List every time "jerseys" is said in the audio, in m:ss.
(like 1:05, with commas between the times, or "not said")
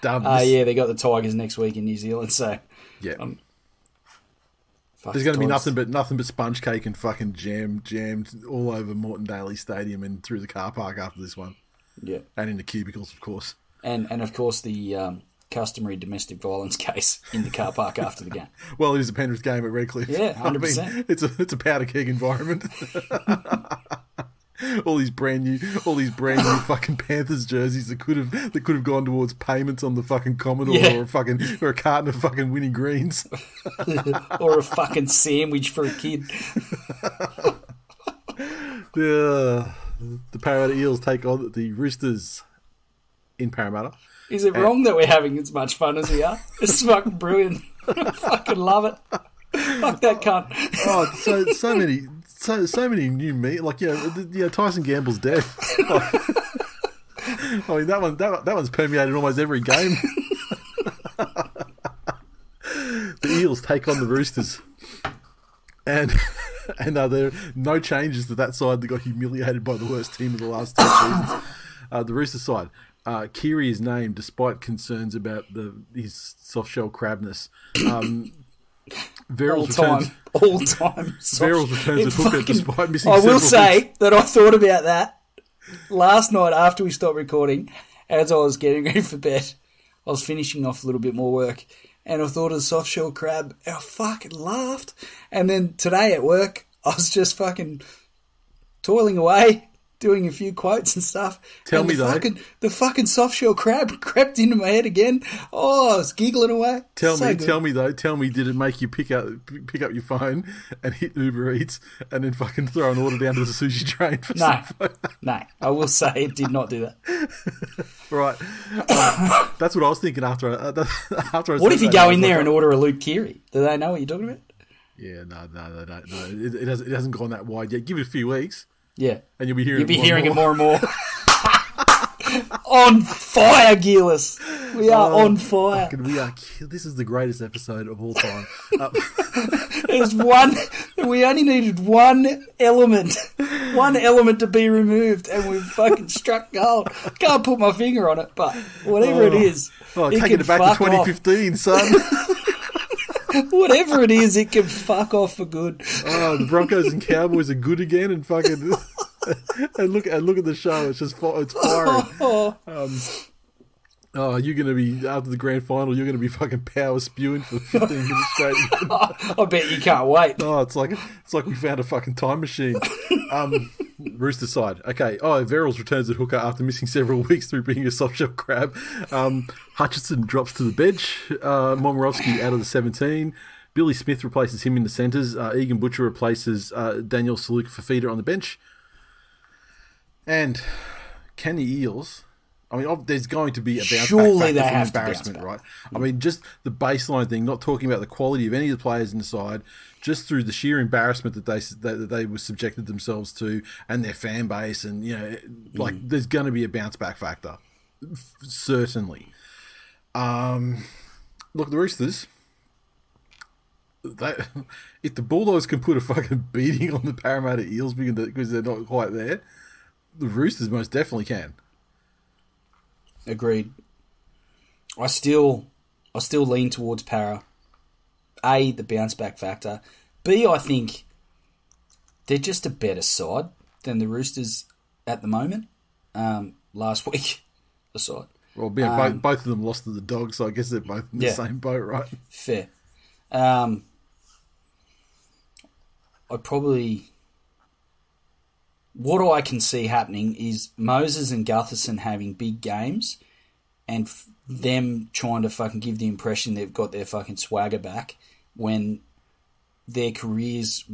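0:27.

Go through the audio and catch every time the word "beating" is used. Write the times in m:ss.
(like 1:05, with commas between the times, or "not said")
3:36.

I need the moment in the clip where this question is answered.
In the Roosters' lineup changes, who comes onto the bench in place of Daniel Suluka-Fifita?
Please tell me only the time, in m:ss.
3:05.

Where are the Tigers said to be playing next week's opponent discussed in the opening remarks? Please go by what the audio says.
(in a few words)
New Zealand.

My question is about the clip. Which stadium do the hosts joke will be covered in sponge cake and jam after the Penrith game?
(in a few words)
Moreton Daily Stadium.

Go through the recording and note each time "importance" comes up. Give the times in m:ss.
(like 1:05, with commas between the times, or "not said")
not said.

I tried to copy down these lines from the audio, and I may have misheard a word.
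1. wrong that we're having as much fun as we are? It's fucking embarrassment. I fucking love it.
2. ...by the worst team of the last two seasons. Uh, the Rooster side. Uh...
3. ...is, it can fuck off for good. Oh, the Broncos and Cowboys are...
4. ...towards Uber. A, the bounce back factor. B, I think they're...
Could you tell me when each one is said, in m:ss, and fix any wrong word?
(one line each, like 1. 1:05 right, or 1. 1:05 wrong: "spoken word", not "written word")
1. 0:44 wrong: "brilliant", not "embarrassment"
2. 1:09 right
3. 2:34 right
4. 3:46 wrong: "Para", not "Uber".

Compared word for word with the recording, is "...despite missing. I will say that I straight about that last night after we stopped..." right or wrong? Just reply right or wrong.
wrong.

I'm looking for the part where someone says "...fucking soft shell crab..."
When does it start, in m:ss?
1:42.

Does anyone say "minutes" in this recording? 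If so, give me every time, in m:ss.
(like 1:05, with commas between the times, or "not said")
2:47.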